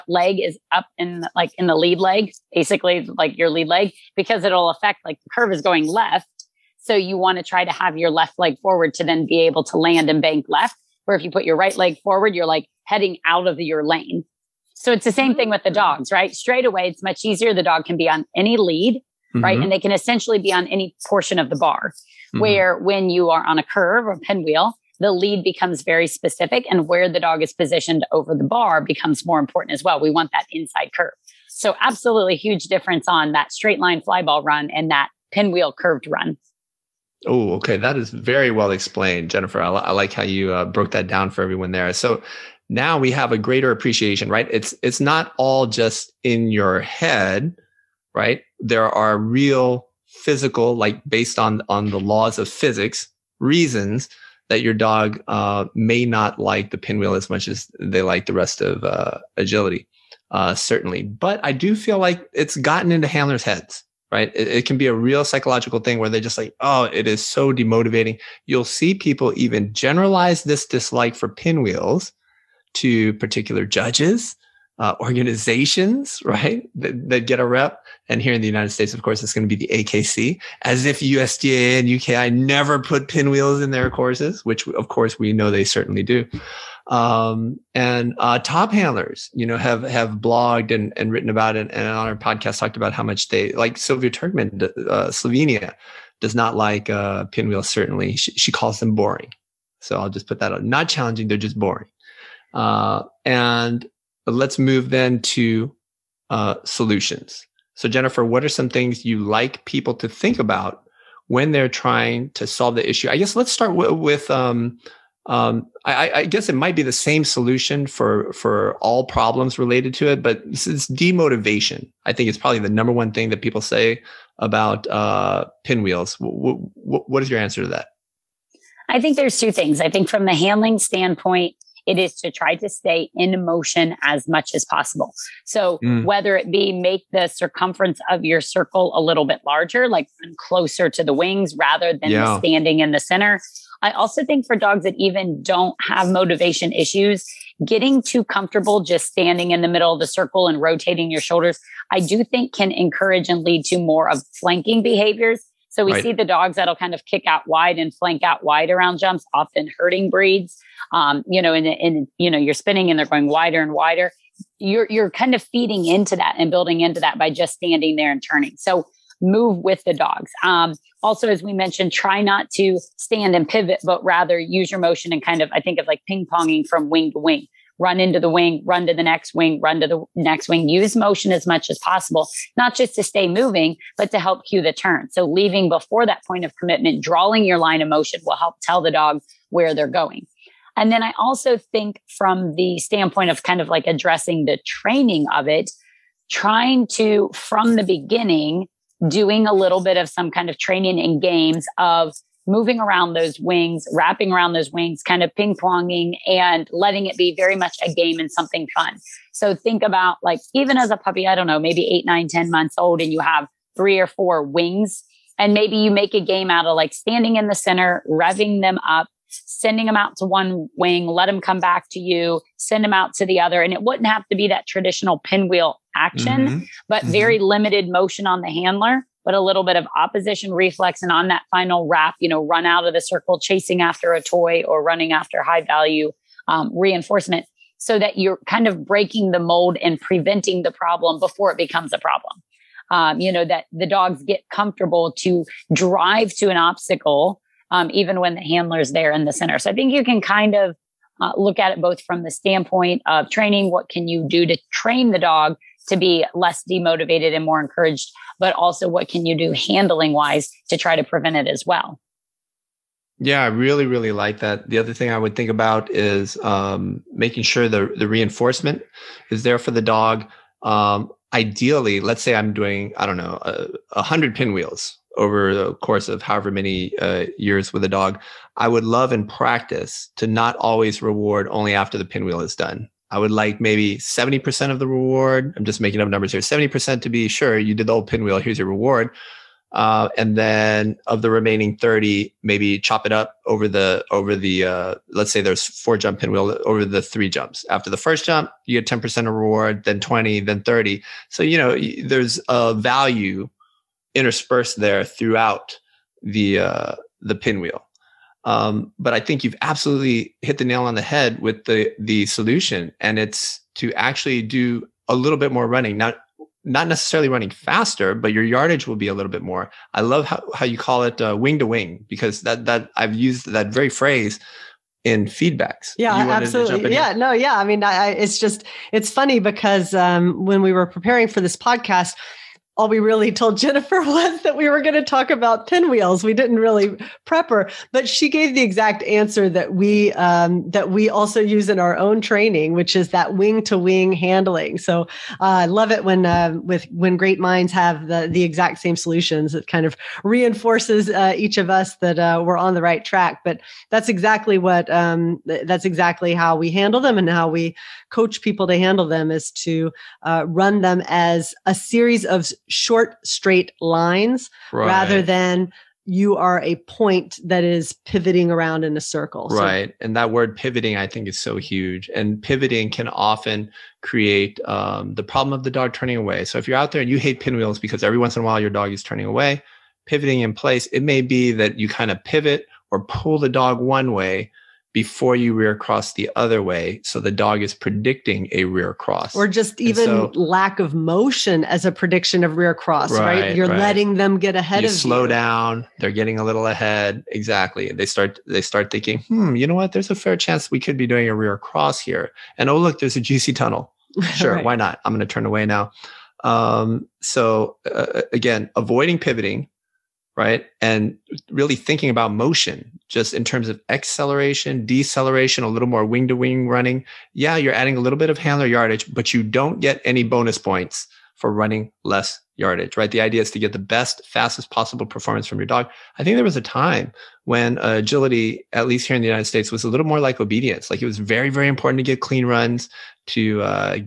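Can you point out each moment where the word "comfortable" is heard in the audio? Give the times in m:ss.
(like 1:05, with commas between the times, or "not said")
2:28, 4:04.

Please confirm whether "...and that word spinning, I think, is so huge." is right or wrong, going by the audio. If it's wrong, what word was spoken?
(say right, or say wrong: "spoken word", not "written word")
wrong: "pivoting", not "spinning".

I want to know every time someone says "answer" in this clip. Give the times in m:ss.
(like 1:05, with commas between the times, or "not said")
2:07, 5:39.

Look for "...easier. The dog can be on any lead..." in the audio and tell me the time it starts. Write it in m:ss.
0:17.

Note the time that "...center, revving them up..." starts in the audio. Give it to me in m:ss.
3:37.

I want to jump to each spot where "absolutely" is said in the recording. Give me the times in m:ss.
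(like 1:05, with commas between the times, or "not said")
0:31, 5:09, 5:26.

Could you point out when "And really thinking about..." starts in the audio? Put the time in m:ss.
6:50.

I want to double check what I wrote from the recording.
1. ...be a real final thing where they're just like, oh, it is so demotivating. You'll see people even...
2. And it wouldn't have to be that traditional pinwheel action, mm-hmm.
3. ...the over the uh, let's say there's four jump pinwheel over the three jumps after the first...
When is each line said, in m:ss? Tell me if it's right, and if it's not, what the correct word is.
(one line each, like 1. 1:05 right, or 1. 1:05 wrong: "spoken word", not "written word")
1. 1:04 wrong: "psychological", not "final"
2. 3:43 right
3. 4:53 right.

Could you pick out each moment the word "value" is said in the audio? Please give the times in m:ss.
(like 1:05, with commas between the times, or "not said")
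3:55, 5:02.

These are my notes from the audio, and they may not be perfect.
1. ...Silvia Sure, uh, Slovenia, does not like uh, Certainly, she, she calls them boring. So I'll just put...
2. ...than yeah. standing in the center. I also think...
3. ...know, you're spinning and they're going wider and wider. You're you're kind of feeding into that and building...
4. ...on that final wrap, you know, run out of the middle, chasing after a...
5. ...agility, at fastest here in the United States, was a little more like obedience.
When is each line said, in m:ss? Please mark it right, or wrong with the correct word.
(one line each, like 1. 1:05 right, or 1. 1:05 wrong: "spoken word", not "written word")
1. 1:33 wrong: "Trkman", not "Sure"
2. 2:21 right
3. 2:42 right
4. 3:51 wrong: "circle", not "middle"
5. 7:07 wrong: "least", not "fastest".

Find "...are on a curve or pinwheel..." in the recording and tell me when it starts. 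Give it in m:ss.
0:23.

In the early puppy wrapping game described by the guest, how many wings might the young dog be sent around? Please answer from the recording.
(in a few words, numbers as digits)
3 or 4.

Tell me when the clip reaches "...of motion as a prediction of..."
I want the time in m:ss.
6:30.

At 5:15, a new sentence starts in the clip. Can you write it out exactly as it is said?
Not not necessarily running faster, but your yardage will be a little bit more.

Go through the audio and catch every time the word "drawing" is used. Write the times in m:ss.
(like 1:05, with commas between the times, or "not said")
3:07.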